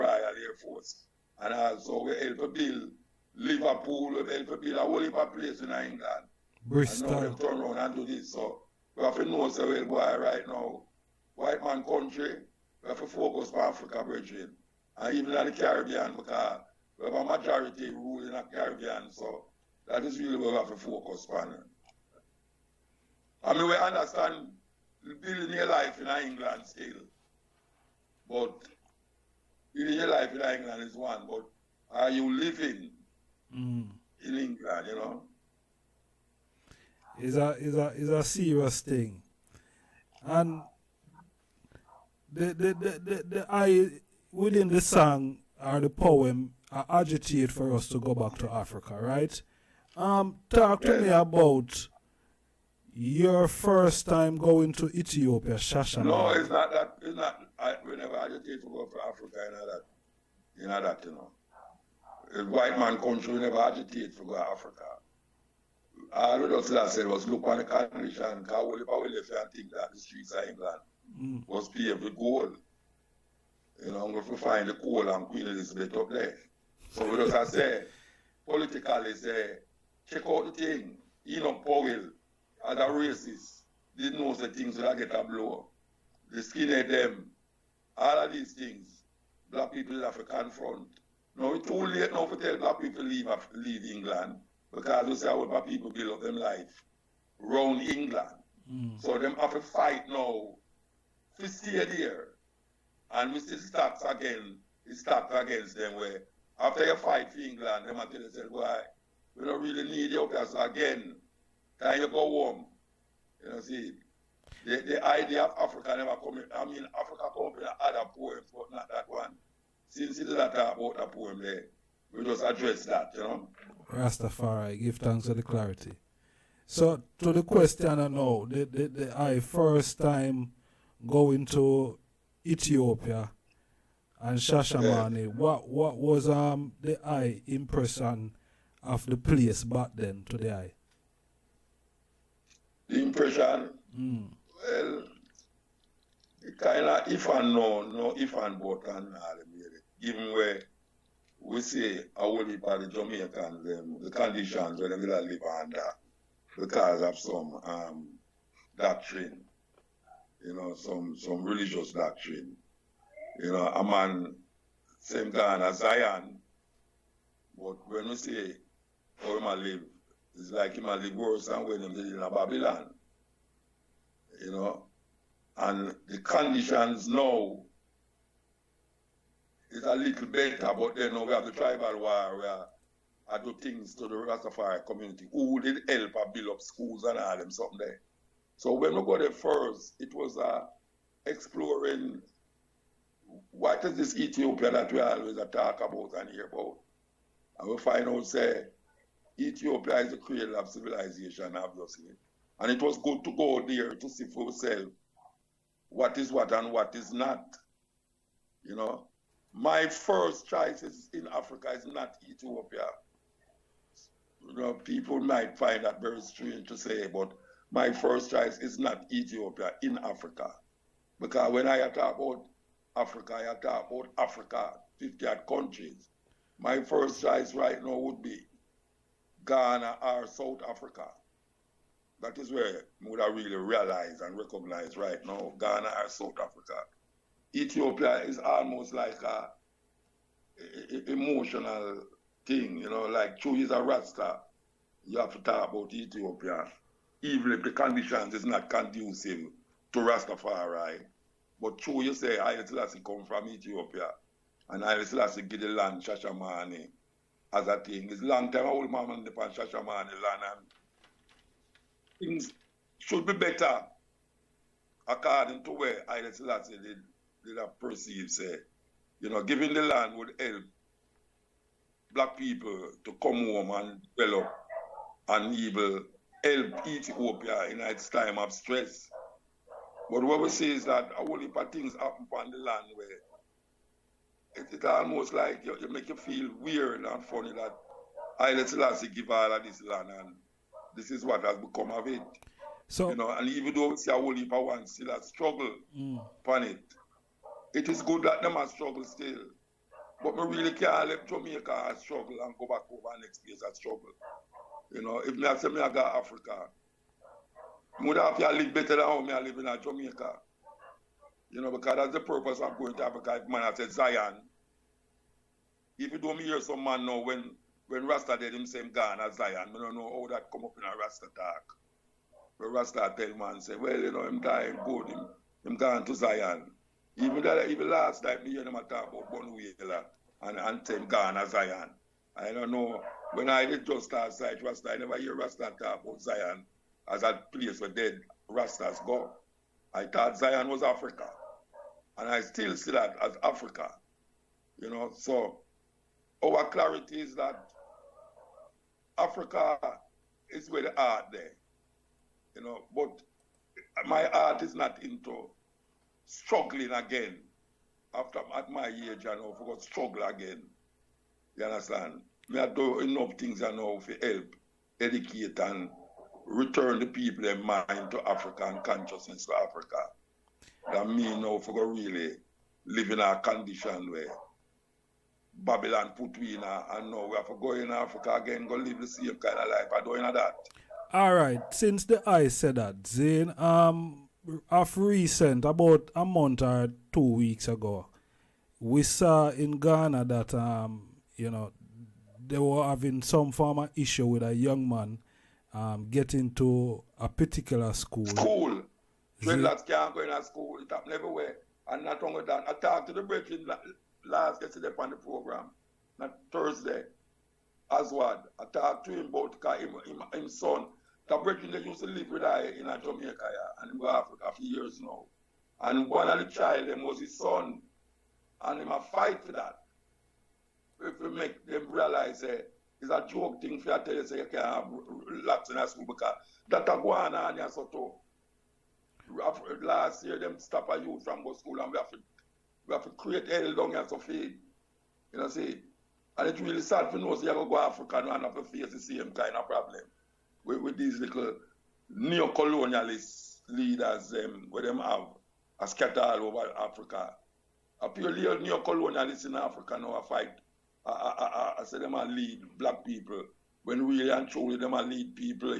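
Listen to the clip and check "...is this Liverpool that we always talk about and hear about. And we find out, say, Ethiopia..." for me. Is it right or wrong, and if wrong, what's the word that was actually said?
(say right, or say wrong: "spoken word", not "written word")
wrong: "Ethiopia", not "Liverpool".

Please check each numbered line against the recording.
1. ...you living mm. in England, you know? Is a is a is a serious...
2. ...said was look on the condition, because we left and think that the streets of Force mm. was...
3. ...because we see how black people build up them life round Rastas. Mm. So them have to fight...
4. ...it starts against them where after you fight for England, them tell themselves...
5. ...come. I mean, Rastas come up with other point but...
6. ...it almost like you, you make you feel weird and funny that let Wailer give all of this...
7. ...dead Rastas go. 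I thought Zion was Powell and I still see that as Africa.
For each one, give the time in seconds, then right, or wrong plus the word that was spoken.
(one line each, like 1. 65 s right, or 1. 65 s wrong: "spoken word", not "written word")
1. 32 s right
2. 66 s wrong: "England", not "Force"
3. 94 s wrong: "England", not "Rastas"
4. 104 s right
5. 116 s wrong: "Africa", not "Rastas"
6. 284 s wrong: "Selassie", not "Wailer"
7. 337 s wrong: "Africa", not "Powell".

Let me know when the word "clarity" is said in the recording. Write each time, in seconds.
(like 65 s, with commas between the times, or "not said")
125 s, 346 s.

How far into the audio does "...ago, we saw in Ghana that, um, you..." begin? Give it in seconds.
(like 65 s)
387 s.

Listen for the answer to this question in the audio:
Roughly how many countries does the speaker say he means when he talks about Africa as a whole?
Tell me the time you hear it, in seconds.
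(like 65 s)
224 s.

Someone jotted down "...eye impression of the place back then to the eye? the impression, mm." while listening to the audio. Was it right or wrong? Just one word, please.
right.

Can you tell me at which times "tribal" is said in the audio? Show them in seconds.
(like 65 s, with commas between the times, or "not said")
181 s.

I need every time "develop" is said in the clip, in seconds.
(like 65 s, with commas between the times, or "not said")
274 s.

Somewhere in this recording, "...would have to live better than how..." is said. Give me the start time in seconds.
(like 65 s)
307 s.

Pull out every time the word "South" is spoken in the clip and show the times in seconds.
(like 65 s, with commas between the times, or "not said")
230 s, 236 s.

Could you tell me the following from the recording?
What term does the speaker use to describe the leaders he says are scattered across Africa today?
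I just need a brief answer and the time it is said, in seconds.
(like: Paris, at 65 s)
neo-colonialist leaders, at 442 s.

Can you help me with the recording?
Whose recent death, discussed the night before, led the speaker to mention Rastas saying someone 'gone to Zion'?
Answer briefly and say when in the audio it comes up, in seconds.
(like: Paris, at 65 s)
Bunny Wailer, at 329 s.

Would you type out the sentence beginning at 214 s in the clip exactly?
You know, people might find that very strange to say, but my first choice is not Ethiopia in Africa.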